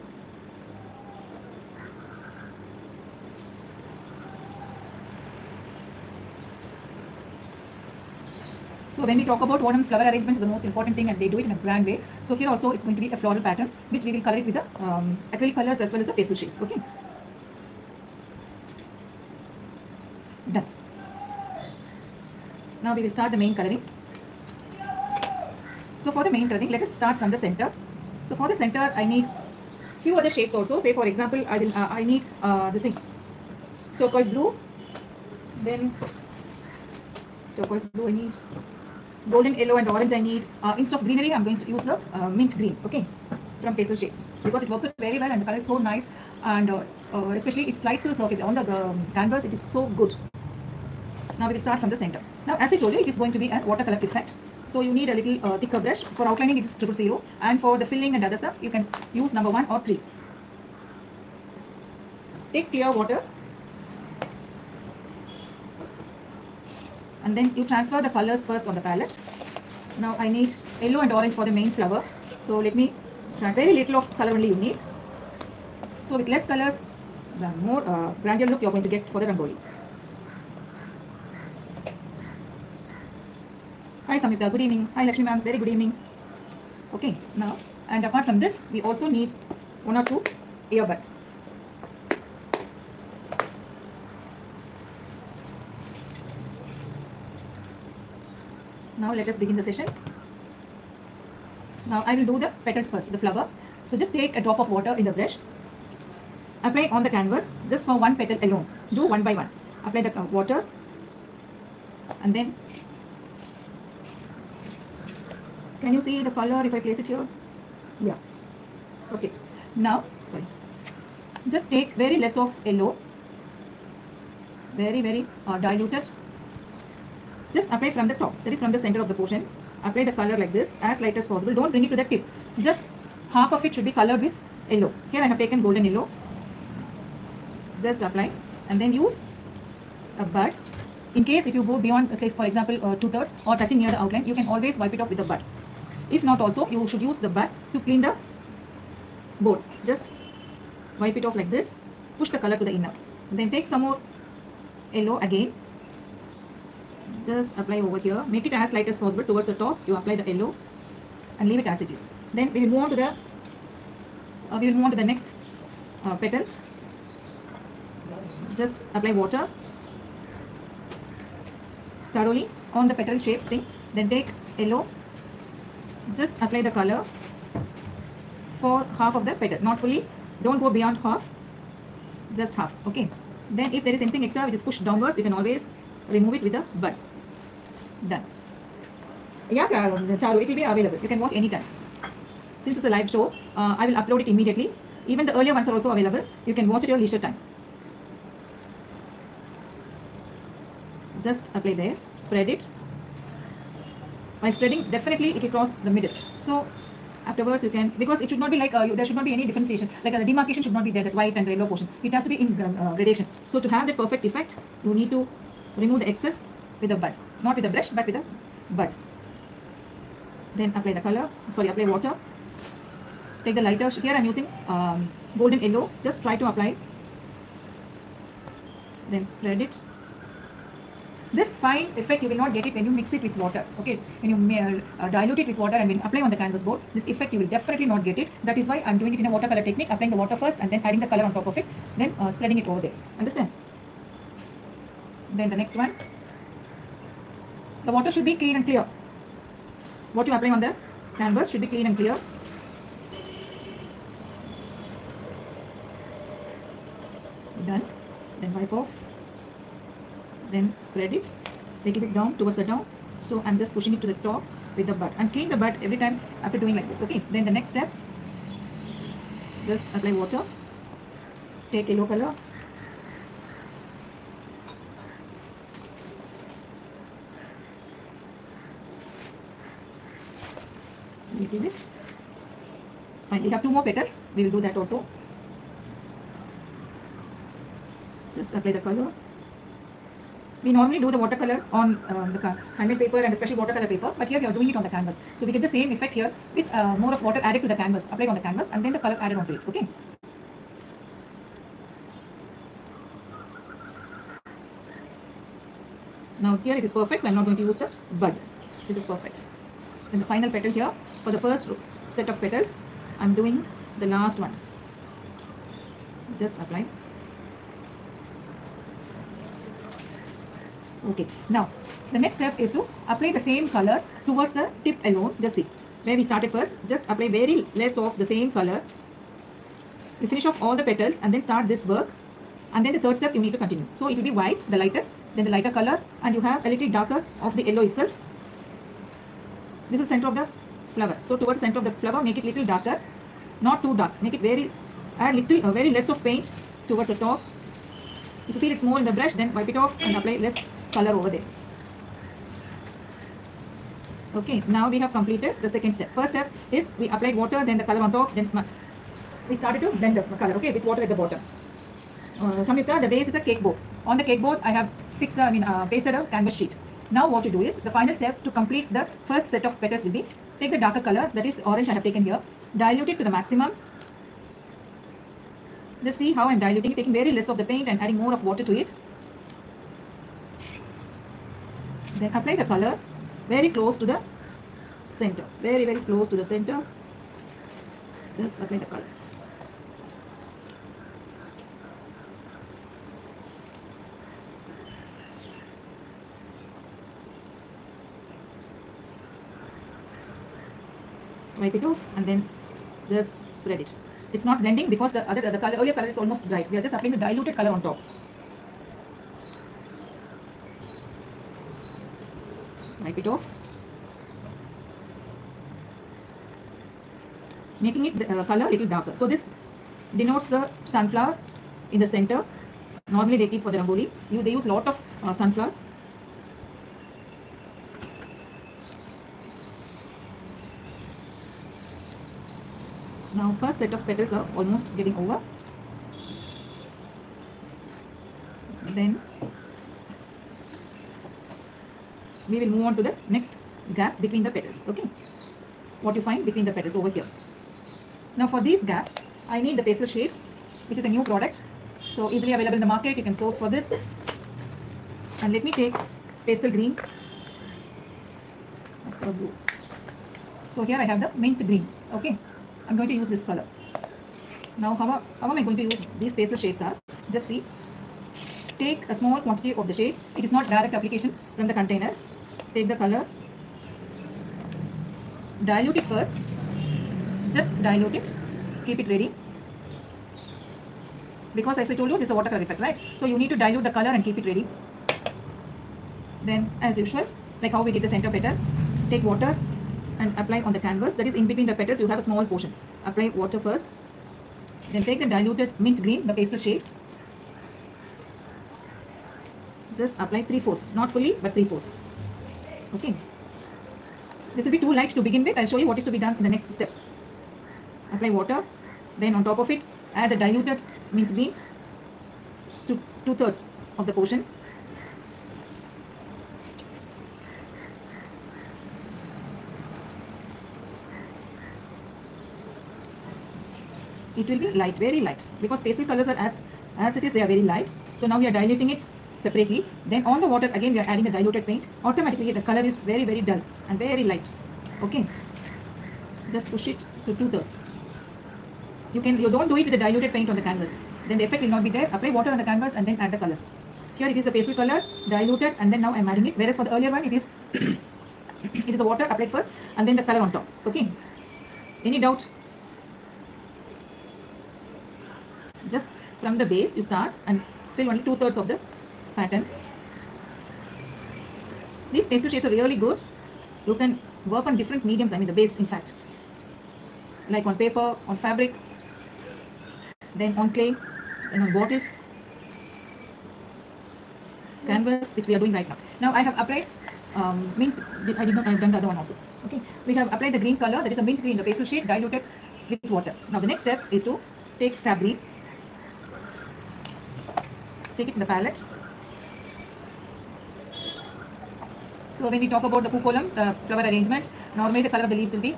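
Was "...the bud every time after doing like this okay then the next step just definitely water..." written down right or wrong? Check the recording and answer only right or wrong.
wrong.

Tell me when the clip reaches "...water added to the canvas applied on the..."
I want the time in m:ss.
4:57.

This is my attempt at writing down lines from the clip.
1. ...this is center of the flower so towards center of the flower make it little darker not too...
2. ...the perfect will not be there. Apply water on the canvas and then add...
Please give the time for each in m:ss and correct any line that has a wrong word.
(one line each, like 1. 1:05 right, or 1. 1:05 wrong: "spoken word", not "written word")
1. 5:39 right
2. 9:01 wrong: "effect", not "perfect".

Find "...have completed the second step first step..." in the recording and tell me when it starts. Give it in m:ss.
5:54.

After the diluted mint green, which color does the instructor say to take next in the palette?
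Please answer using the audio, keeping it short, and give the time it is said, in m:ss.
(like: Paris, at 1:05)
Sap green, at 9:44.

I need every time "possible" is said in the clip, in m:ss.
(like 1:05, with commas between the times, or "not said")
2:11, 2:39.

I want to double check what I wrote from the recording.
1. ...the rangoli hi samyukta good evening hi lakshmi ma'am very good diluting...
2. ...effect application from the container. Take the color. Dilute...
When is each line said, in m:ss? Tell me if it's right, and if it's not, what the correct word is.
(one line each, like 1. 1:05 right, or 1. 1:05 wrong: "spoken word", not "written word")
1. 1:19 wrong: "evening", not "diluting"
2. 7:50 wrong: "direct", not "effect".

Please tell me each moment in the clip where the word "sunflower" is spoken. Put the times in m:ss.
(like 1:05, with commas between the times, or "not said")
7:00, 7:05.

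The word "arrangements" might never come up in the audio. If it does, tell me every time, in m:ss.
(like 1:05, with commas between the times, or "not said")
0:10, 9:54.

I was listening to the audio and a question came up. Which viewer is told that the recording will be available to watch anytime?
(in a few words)
Charu.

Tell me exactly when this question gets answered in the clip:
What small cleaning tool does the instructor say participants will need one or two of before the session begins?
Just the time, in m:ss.
1:30.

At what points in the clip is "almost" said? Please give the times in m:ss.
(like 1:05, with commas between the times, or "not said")
6:46, 7:14.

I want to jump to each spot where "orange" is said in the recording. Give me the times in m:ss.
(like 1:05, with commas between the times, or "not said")
0:39, 1:11, 6:11.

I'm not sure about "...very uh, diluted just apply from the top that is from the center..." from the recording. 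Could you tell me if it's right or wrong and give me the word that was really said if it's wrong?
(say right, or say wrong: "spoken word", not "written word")
right.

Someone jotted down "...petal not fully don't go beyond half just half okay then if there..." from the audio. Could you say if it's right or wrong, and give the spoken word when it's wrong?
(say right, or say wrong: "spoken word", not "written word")
right.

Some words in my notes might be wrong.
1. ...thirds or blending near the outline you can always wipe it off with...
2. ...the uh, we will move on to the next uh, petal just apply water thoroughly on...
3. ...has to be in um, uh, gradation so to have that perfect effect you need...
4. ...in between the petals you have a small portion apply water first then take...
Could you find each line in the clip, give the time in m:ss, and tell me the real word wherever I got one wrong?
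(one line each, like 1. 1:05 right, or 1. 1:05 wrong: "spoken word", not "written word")
1. 2:23 wrong: "touching", not "blending"
2. 2:42 right
3. 3:32 right
4. 8:11 right.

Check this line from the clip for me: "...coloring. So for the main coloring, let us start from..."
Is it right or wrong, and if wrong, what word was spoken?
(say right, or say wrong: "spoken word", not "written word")
right.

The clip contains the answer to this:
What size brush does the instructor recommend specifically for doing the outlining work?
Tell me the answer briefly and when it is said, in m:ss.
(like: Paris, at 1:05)
Triple zero, at 0:56.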